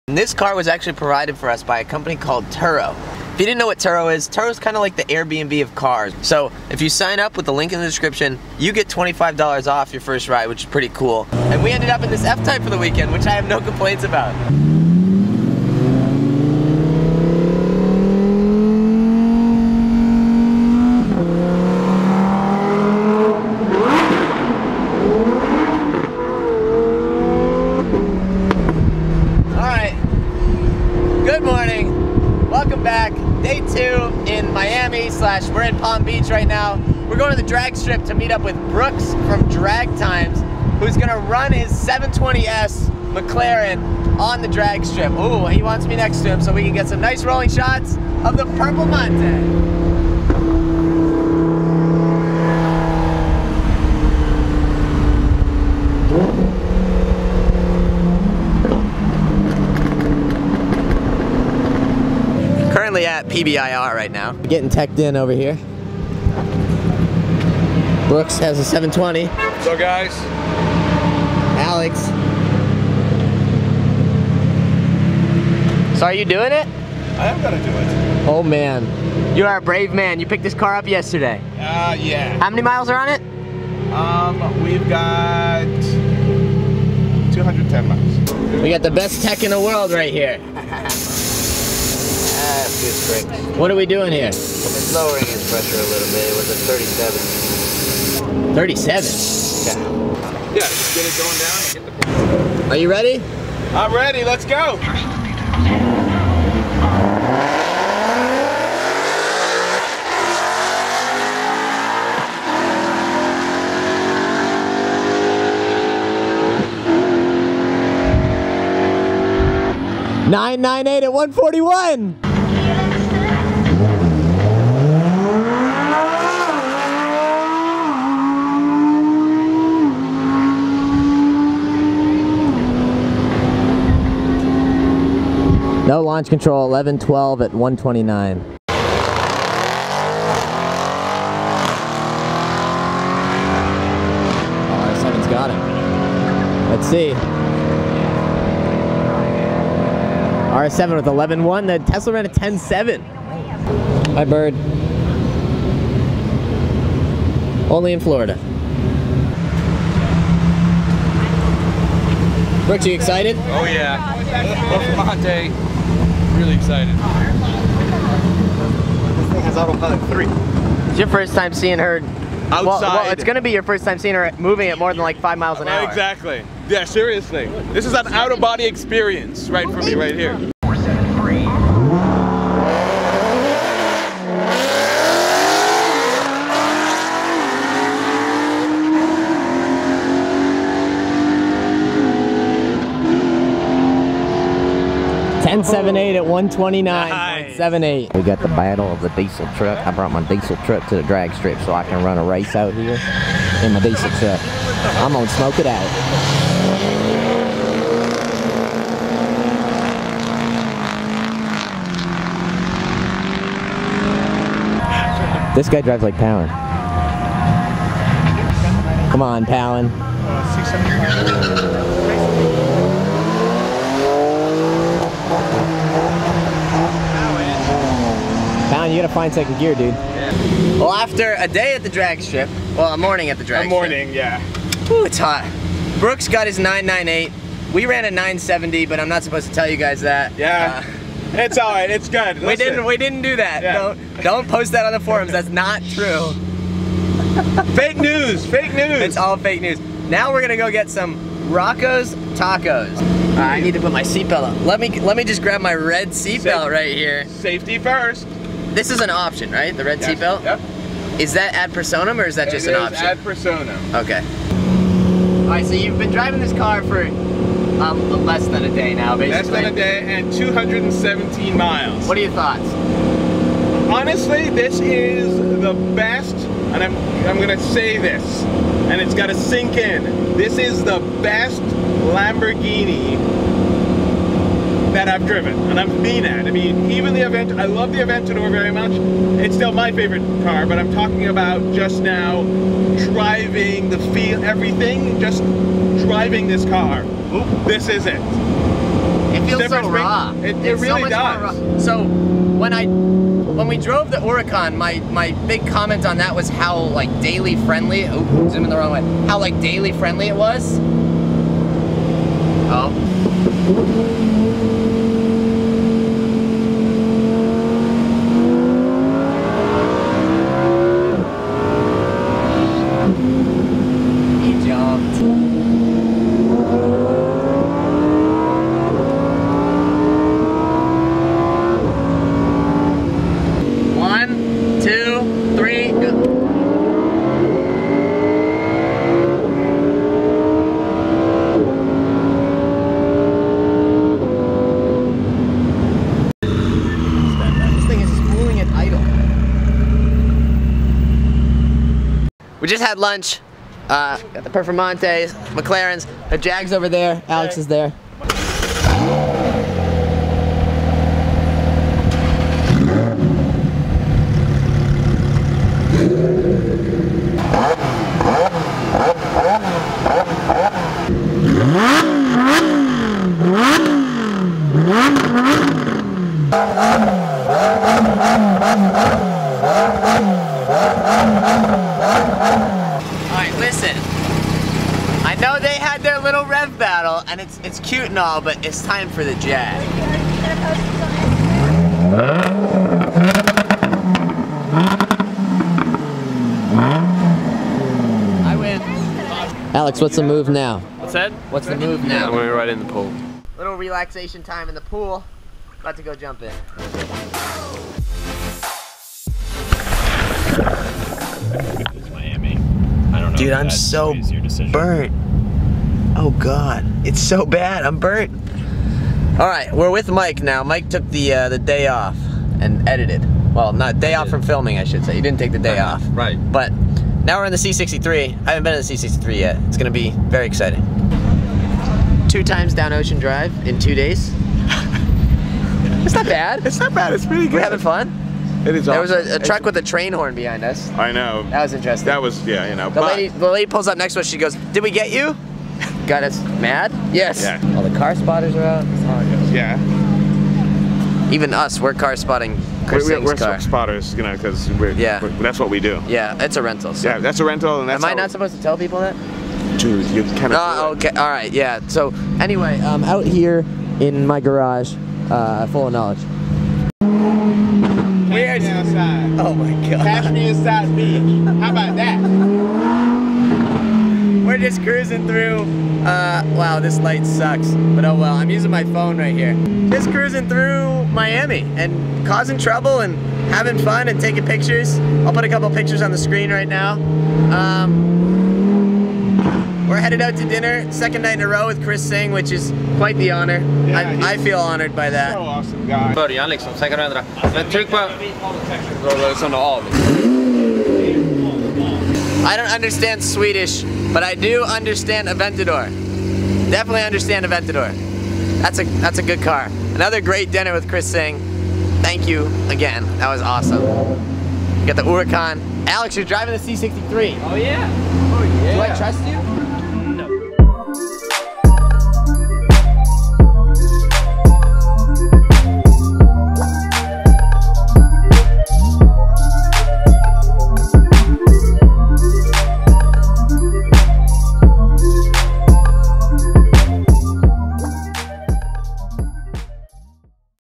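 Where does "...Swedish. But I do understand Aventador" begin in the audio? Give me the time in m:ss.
8:23.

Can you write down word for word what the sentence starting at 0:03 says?
If you didn't know what Turo is, Turo is kind of like the Airbnb of cars.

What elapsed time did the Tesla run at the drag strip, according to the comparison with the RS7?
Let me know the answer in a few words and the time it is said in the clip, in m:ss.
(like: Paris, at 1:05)
10.7, at 2:32.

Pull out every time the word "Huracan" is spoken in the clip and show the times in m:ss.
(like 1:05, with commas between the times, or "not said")
5:04, 8:35.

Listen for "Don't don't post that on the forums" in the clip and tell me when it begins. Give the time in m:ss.
4:03.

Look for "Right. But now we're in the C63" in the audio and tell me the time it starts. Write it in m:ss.
7:06.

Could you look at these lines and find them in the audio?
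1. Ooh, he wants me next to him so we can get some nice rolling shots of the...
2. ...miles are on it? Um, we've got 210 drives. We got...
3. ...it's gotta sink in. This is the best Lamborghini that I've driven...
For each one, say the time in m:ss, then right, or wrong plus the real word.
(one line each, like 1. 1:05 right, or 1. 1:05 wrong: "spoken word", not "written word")
1. 0:45 right
2. 1:22 wrong: "miles", not "drives"
3. 4:39 right.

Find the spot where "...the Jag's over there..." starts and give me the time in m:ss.
5:56.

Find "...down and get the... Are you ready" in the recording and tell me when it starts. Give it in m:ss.
1:41.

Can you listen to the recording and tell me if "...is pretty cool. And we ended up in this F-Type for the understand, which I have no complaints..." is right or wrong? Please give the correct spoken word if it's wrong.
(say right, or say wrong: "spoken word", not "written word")
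wrong: "weekend", not "understand".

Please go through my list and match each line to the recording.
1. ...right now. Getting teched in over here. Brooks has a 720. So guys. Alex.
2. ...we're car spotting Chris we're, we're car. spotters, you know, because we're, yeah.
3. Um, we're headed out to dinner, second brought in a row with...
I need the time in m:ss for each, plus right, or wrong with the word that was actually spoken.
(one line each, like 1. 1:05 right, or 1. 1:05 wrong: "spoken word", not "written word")
1. 1:03 right
2. 7:31 right
3. 8:07 wrong: "night", not "brought".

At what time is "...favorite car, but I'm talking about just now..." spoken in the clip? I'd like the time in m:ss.
4:49.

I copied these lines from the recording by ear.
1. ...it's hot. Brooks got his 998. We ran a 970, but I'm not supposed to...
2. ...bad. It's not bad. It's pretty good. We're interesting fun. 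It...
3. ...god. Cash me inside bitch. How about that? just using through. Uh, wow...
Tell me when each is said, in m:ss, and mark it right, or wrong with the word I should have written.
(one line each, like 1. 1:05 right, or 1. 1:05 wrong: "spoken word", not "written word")
1. 3:55 right
2. 7:16 wrong: "having", not "interesting"
3. 7:49 wrong: "cruising", not "using".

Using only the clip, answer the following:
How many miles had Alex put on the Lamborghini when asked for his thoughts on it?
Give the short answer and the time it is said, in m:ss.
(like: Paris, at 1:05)
217, at 4:30.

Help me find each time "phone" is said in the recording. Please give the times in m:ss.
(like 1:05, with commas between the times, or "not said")
7:58.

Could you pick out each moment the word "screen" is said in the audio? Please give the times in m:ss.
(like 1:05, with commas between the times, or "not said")
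8:06.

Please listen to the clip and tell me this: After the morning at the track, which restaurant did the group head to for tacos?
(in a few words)
Rocco's tacos.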